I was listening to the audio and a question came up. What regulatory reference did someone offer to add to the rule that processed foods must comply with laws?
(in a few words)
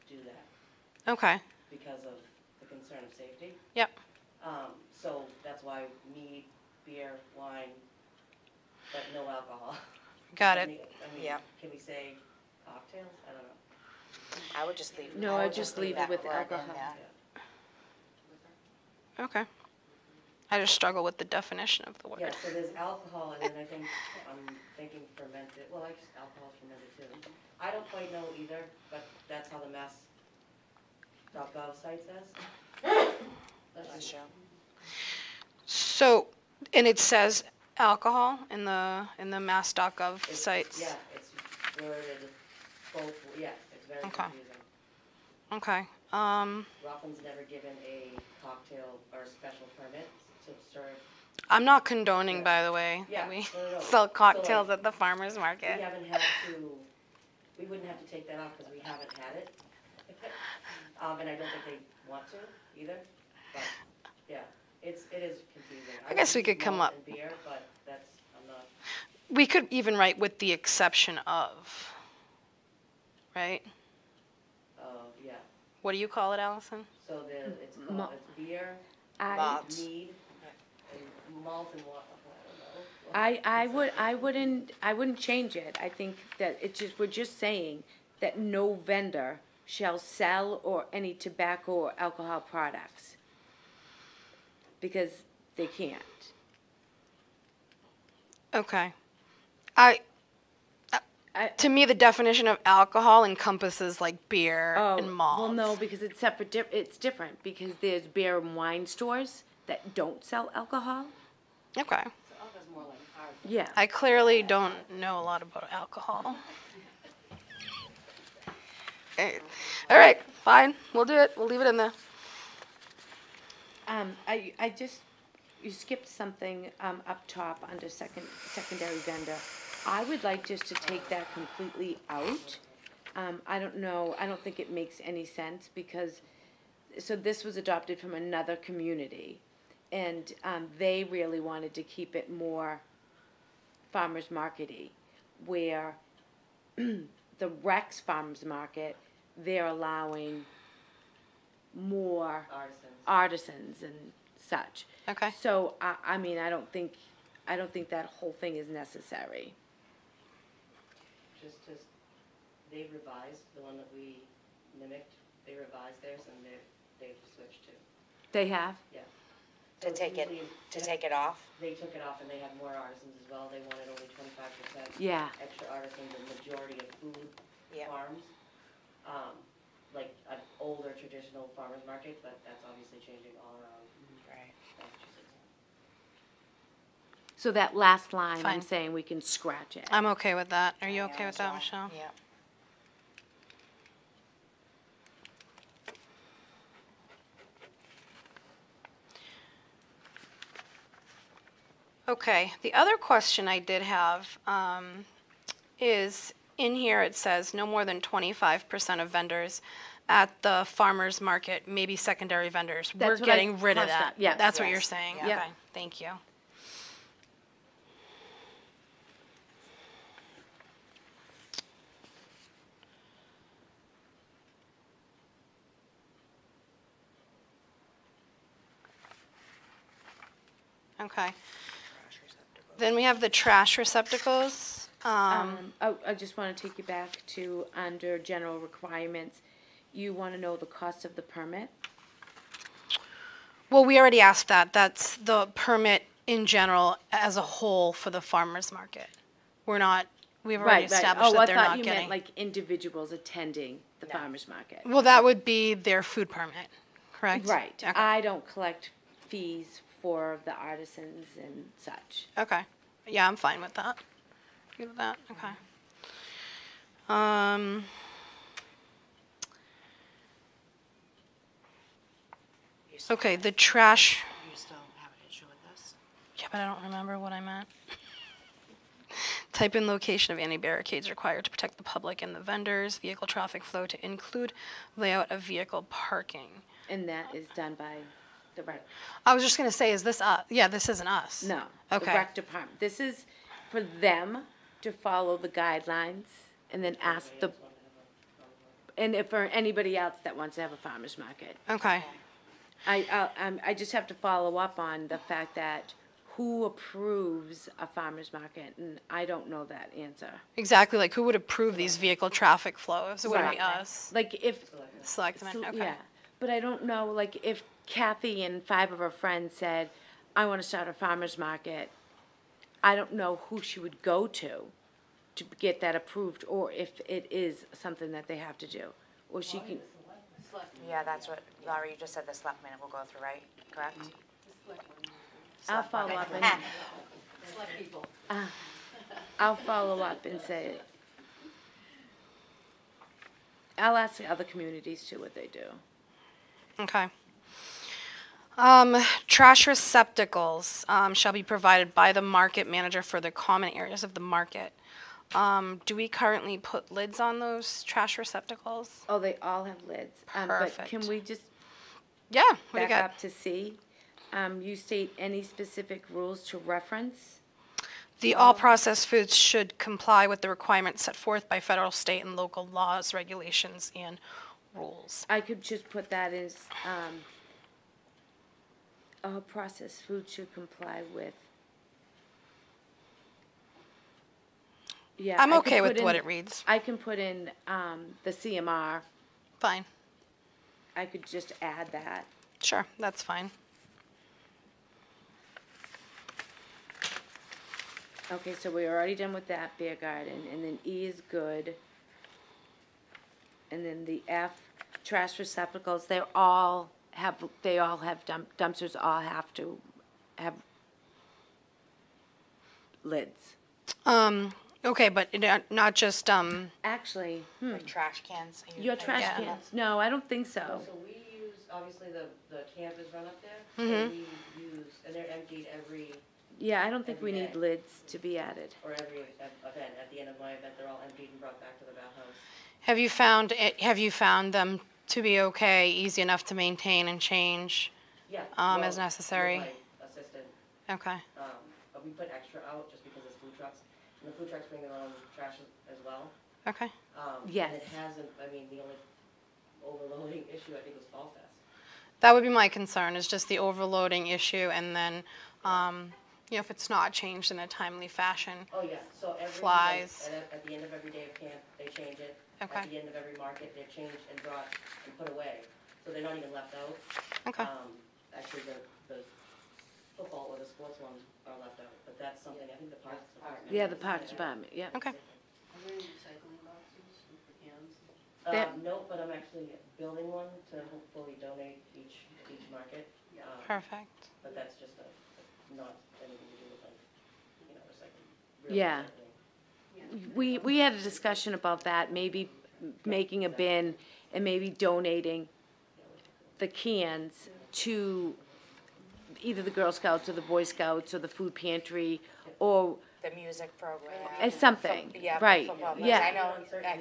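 CMR.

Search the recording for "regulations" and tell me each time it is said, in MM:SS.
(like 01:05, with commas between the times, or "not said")
06:13.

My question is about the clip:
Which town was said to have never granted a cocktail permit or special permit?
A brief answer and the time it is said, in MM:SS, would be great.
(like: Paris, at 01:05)
Rockland, at 00:46.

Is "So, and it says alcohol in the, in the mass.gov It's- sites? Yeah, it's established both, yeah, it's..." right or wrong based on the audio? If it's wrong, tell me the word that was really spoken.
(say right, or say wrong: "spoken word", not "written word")
wrong: "worded", not "established".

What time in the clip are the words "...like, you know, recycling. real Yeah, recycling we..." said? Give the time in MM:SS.
08:06.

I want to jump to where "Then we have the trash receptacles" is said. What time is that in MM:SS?
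03:52.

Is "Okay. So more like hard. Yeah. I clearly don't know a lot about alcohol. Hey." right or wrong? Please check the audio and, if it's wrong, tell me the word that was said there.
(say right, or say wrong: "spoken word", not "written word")
right.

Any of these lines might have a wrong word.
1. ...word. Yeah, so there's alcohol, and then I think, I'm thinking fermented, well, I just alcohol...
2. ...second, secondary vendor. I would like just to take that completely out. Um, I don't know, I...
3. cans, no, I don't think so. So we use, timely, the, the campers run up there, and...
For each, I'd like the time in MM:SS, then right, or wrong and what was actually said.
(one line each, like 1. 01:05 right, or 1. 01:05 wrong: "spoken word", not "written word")
1. 00:22 right
2. 02:07 right
3. 06:59 wrong: "obviously", not "timely".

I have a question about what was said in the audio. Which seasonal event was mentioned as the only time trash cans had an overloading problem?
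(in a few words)
Fall Fest.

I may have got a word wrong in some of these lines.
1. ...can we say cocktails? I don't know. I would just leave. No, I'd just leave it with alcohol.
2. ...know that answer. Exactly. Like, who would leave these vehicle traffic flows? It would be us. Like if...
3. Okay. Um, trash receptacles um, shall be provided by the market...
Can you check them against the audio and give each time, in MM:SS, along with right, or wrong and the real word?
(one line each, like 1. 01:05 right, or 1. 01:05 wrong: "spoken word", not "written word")
1. 00:11 right
2. 05:09 wrong: "approve", not "leave"
3. 05:46 right.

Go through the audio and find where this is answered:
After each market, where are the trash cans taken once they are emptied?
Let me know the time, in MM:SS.
07:11.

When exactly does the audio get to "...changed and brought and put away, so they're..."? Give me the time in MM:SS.
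07:43.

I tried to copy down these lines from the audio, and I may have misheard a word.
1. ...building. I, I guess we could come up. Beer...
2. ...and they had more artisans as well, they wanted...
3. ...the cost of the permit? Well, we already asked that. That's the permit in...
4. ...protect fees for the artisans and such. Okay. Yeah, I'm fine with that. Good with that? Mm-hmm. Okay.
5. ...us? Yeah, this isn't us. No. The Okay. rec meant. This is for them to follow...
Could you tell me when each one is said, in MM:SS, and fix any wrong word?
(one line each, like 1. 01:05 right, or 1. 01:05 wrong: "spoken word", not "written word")
1. 01:05 wrong: "confusing", not "building"
2. 02:52 right
3. 04:00 right
4. 04:18 wrong: "collect", not "protect"
5. 04:50 wrong: "department", not "meant".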